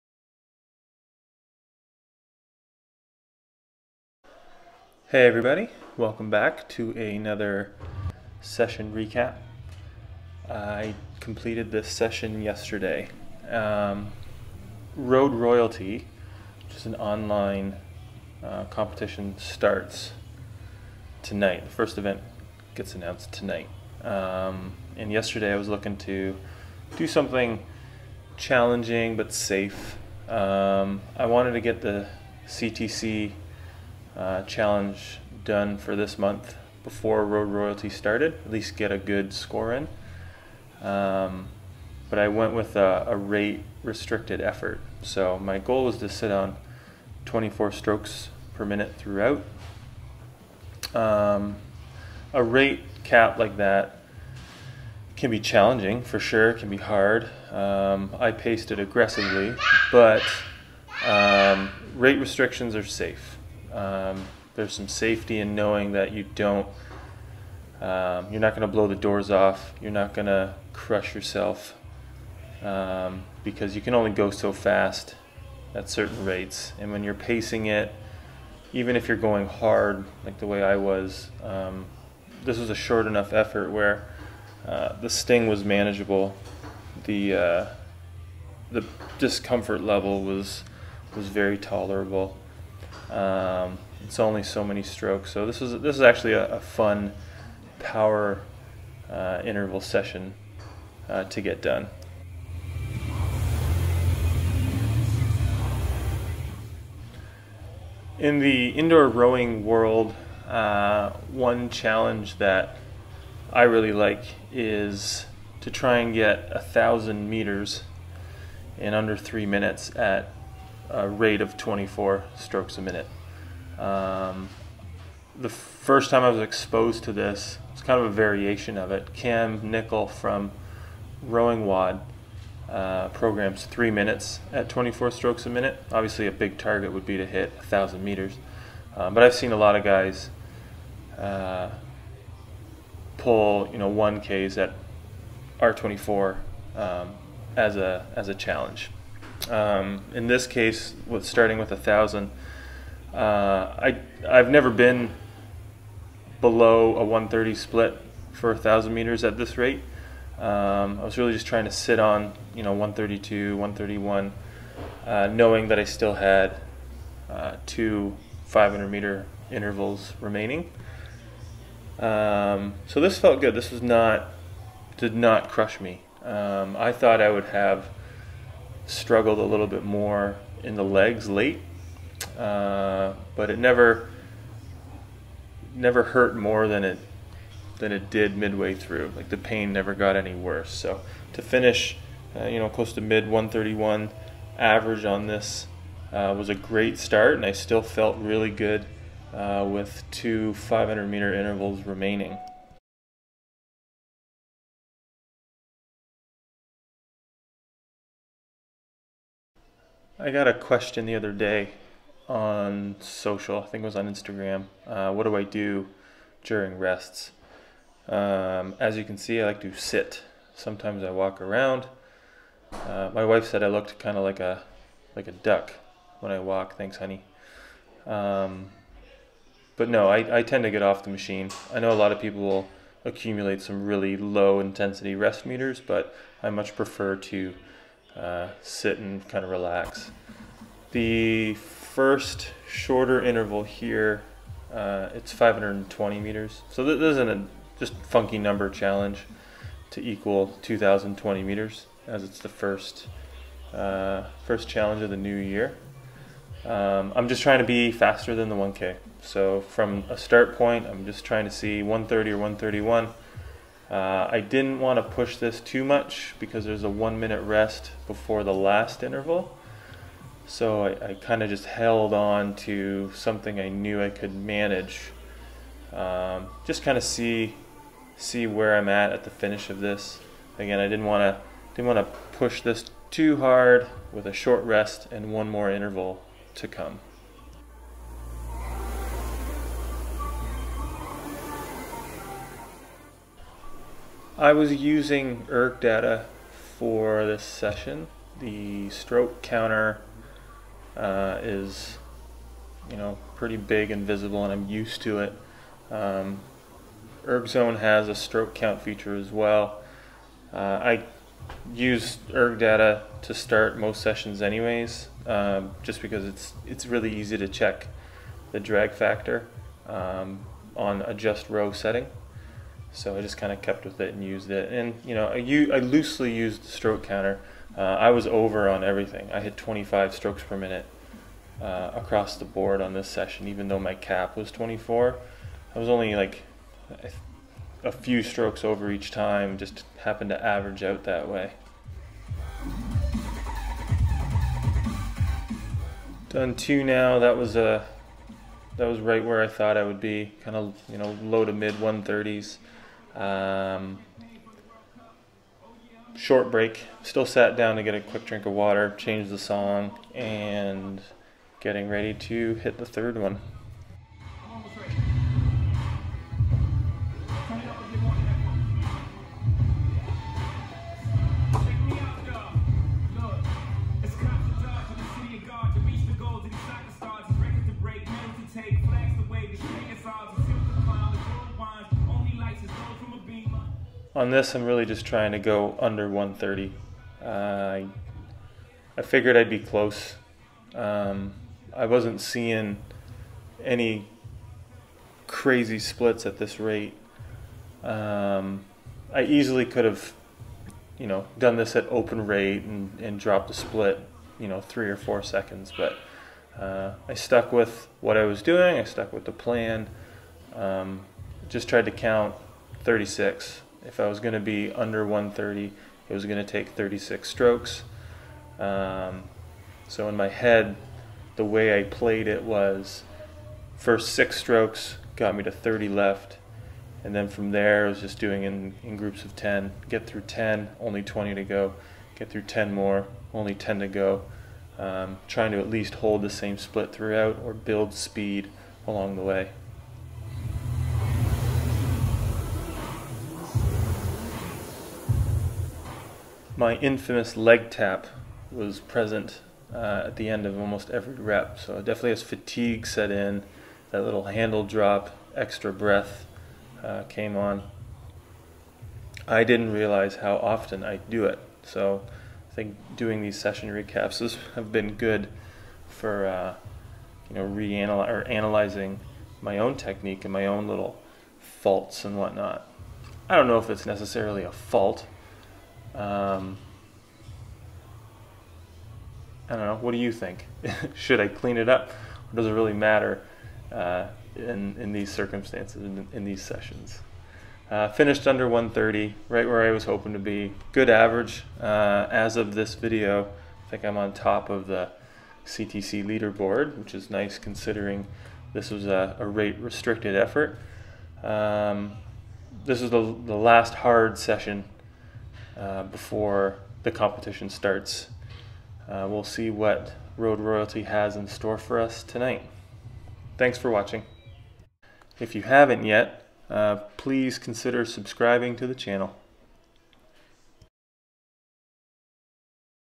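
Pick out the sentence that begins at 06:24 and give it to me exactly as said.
on this, I'm really just trying to go under 130.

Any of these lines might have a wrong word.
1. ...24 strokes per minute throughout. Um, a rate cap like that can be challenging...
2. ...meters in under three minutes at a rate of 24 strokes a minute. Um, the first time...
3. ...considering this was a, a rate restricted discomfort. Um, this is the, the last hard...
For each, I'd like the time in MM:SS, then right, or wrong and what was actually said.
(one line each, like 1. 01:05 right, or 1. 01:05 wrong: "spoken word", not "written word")
1. 00:47 right
2. 01:57 right
3. 08:17 wrong: "effort", not "discomfort".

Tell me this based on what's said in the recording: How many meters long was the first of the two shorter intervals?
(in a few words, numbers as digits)
520 meters.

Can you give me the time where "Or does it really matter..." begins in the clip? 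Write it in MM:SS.
08:01.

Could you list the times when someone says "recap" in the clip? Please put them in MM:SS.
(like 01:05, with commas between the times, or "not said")
00:08, 07:43.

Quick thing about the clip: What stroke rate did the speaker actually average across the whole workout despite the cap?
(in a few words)
25.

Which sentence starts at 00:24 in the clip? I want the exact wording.
Um, and yesterday I was looking to do something challenging but safe.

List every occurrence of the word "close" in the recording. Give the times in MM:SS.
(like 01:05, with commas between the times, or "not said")
03:12, 06:29.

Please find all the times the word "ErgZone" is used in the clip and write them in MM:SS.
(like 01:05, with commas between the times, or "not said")
05:07.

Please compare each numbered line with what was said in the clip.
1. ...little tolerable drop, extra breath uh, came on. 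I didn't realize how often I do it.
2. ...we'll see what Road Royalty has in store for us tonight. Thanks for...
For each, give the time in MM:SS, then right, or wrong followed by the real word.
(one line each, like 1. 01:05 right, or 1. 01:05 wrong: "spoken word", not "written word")
1. 07:34 wrong: "handle", not "tolerable"
2. 08:29 right.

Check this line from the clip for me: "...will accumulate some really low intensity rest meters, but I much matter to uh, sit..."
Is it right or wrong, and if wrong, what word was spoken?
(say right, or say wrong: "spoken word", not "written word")
wrong: "prefer", not "matter".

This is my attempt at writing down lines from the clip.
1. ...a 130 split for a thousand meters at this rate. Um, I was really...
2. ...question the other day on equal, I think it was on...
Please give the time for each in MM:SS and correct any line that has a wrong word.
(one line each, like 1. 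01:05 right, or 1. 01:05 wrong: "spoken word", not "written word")
1. 02:36 right
2. 03:30 wrong: "social", not "equal".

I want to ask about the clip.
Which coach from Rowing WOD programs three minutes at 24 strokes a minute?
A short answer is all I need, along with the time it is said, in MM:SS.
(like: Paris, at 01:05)
Cam Nichol, at 02:09.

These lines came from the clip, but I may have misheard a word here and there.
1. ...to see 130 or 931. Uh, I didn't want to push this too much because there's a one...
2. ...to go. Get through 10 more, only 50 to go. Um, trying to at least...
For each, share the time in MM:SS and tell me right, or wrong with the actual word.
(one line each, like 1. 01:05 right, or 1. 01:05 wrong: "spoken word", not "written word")
1. 04:21 wrong: "131", not "931"
2. 07:11 wrong: "10", not "50".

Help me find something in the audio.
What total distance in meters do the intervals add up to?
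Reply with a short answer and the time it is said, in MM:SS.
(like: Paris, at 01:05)
2,020 meters, at 04:10.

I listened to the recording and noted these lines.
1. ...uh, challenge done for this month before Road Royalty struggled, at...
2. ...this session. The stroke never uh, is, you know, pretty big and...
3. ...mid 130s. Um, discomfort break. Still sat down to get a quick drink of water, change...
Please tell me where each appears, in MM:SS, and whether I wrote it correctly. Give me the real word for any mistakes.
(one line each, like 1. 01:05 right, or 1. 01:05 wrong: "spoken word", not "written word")
1. 00:34 wrong: "started", not "struggled"
2. 04:57 wrong: "counter", not "never"
3. 05:51 wrong: "short", not "discomfort".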